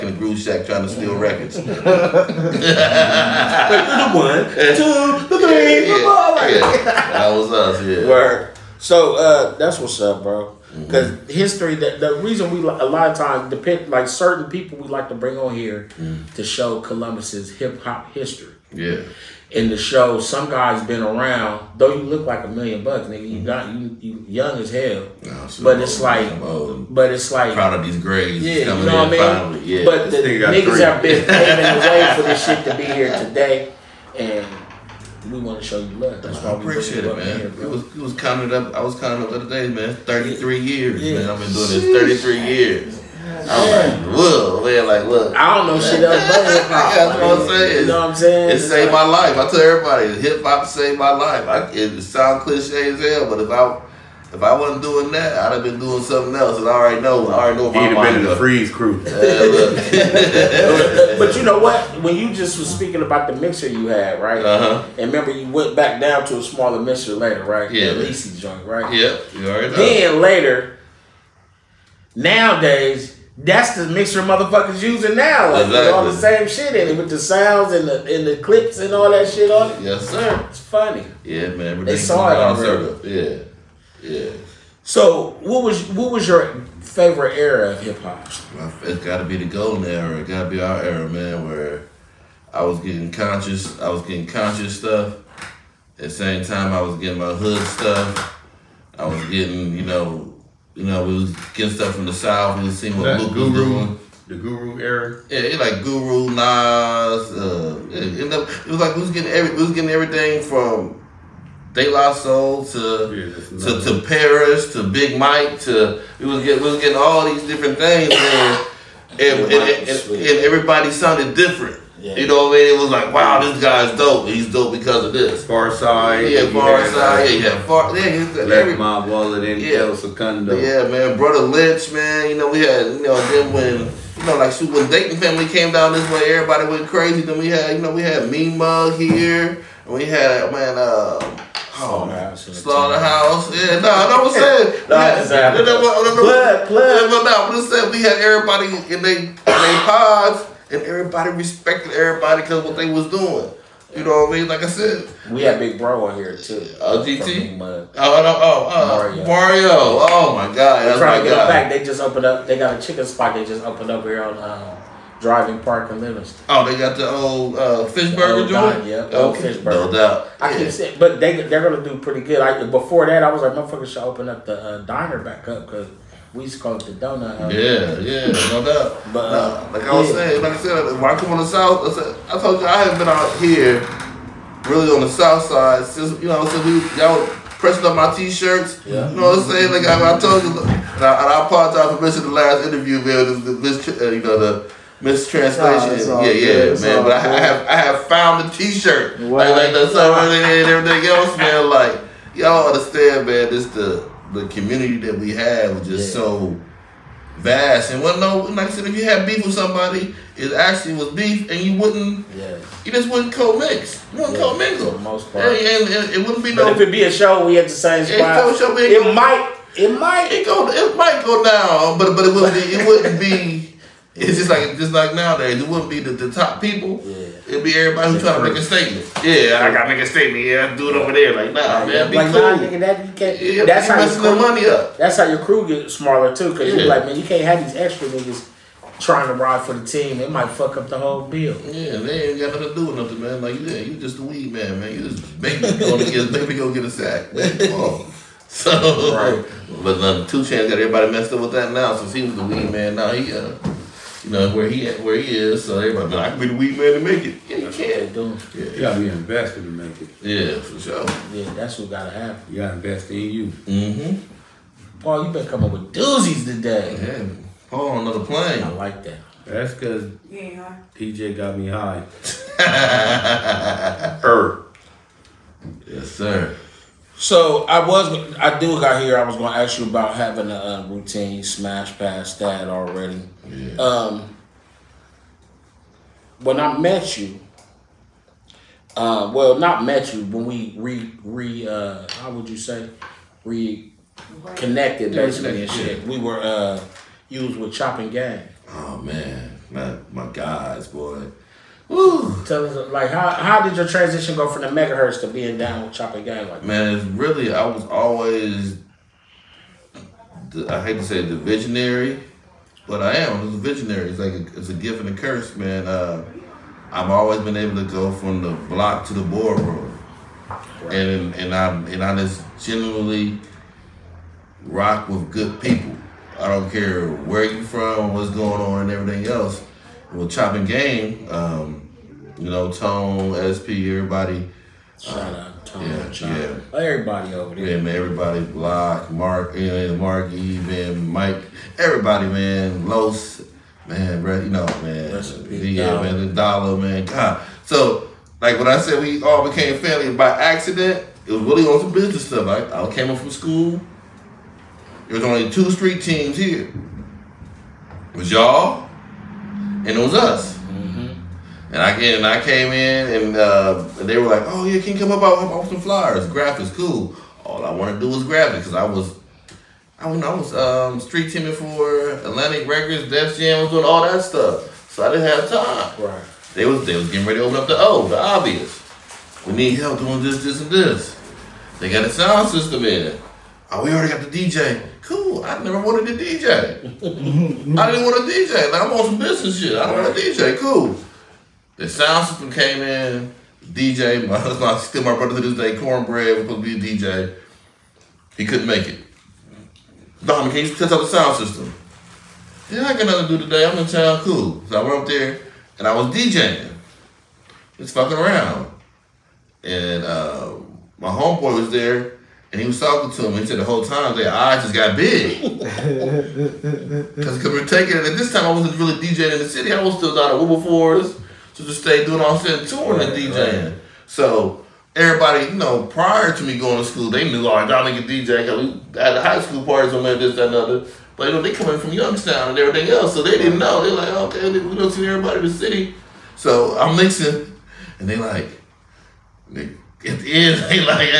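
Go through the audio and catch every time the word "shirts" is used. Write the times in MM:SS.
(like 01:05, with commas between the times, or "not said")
03:08, 03:18.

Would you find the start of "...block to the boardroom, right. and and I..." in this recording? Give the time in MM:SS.
05:18.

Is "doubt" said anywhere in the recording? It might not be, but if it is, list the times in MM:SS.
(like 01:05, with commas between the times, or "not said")
02:49, 02:58.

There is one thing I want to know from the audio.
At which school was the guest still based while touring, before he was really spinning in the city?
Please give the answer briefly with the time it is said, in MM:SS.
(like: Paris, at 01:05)
Wilberforce, at 07:00.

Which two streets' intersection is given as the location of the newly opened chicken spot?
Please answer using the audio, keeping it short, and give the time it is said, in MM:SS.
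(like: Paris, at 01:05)
Driving Park and Livingston, at 02:45.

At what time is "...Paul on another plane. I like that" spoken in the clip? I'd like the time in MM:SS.
04:27.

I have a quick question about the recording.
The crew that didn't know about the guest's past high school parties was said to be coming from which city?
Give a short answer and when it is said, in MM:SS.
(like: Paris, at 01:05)
Youngstown, at 07:11.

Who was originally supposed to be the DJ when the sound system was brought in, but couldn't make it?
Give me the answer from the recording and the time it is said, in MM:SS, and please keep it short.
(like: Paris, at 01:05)
Cornbread, at 06:35.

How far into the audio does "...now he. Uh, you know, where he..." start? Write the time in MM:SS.
04:12.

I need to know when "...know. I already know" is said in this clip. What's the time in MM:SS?
00:57.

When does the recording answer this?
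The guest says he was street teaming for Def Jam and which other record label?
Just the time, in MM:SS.
06:12.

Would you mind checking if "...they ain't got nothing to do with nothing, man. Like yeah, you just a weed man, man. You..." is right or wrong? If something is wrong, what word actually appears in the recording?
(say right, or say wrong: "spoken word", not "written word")
right.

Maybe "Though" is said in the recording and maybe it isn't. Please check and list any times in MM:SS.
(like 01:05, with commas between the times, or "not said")
00:21.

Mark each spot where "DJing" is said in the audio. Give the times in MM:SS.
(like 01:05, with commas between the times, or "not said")
06:46, 06:58, 07:03.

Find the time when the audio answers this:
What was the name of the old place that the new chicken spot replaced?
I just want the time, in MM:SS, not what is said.
02:49.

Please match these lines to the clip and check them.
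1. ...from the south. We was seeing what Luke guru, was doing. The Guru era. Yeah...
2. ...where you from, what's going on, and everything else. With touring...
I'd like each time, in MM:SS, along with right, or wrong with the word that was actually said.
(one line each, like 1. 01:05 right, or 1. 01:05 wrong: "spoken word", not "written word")
1. 01:41 right
2. 05:27 wrong: "chopping", not "touring".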